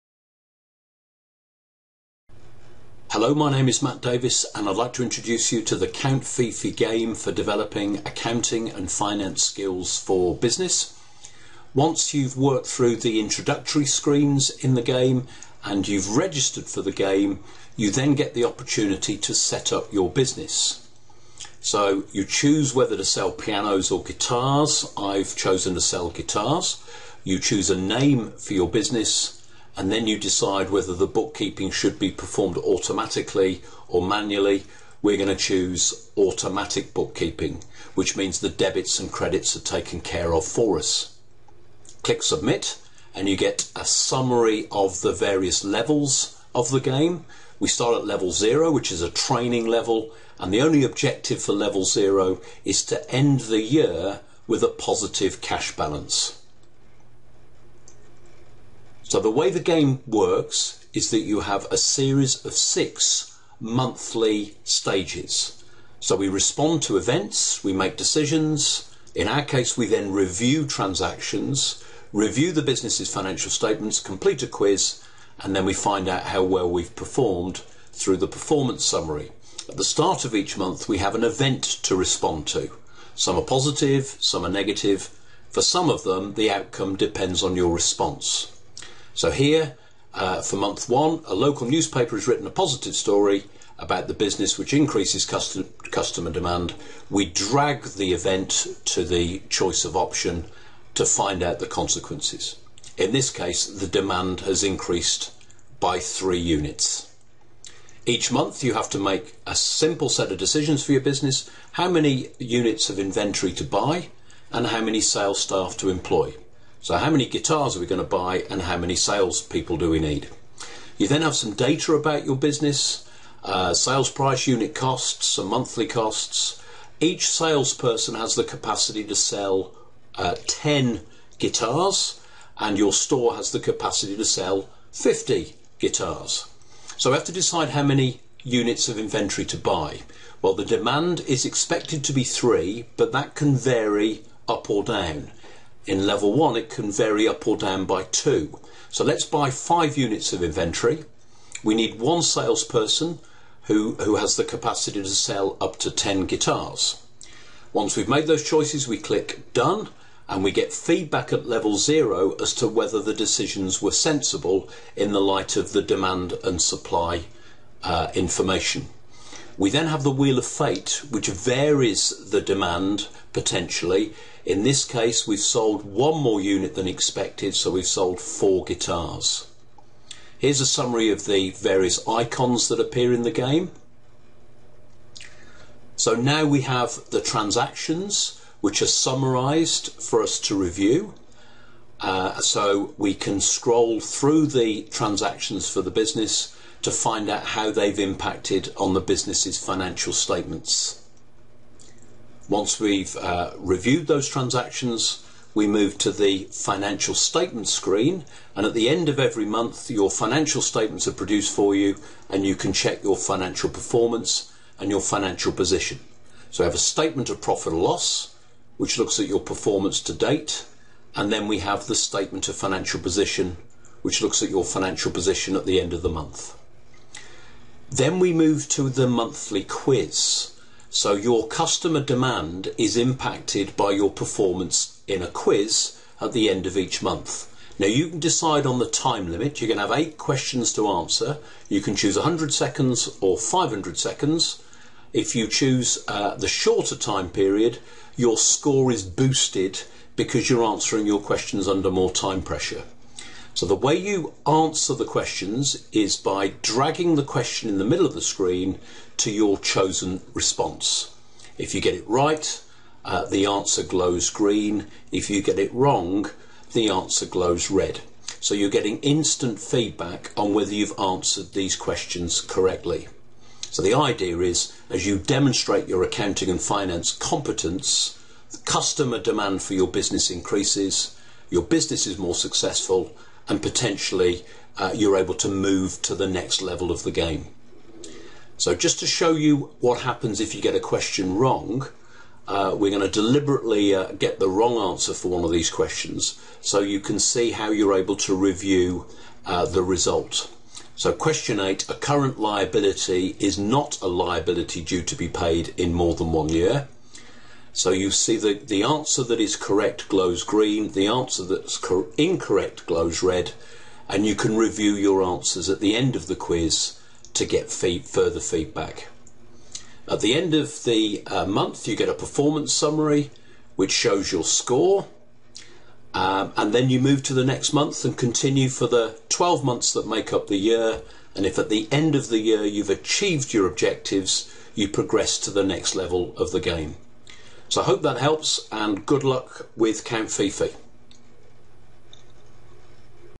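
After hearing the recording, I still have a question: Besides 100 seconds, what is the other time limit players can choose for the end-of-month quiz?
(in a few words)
500 seconds.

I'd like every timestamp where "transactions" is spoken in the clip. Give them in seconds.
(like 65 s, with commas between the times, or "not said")
70 s, 187 s, 194 s, 204 s.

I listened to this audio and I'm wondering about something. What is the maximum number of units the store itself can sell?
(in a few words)
50.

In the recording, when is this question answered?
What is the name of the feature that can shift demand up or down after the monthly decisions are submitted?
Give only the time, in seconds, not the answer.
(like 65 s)
170 s.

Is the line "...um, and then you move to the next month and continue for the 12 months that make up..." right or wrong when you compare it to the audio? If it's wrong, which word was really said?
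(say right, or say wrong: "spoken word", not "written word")
right.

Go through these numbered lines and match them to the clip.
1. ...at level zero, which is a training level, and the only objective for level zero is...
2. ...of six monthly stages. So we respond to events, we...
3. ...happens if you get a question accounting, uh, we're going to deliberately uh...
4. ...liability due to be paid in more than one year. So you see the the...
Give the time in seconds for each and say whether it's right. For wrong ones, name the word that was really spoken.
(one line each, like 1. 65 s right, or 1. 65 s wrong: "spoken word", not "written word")
1. 47 s right
2. 62 s right
3. 290 s wrong: "wrong", not "accounting"
4. 304 s right.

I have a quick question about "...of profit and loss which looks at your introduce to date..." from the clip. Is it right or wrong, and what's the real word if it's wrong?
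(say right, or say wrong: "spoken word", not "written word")
wrong: "performance", not "introduce".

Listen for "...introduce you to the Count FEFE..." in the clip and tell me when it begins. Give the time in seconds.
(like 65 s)
5 s.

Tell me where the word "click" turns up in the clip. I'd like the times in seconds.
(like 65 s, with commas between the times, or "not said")
42 s, 158 s.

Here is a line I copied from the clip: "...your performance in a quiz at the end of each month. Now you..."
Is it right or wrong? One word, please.
right.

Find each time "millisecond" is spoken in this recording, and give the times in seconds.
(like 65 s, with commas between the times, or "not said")
not said.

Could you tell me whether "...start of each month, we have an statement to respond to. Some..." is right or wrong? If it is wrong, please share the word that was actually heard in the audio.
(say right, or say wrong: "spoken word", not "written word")
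wrong: "event", not "statement".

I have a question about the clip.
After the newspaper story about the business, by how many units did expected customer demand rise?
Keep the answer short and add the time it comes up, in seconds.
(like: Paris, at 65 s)
3, at 103 s.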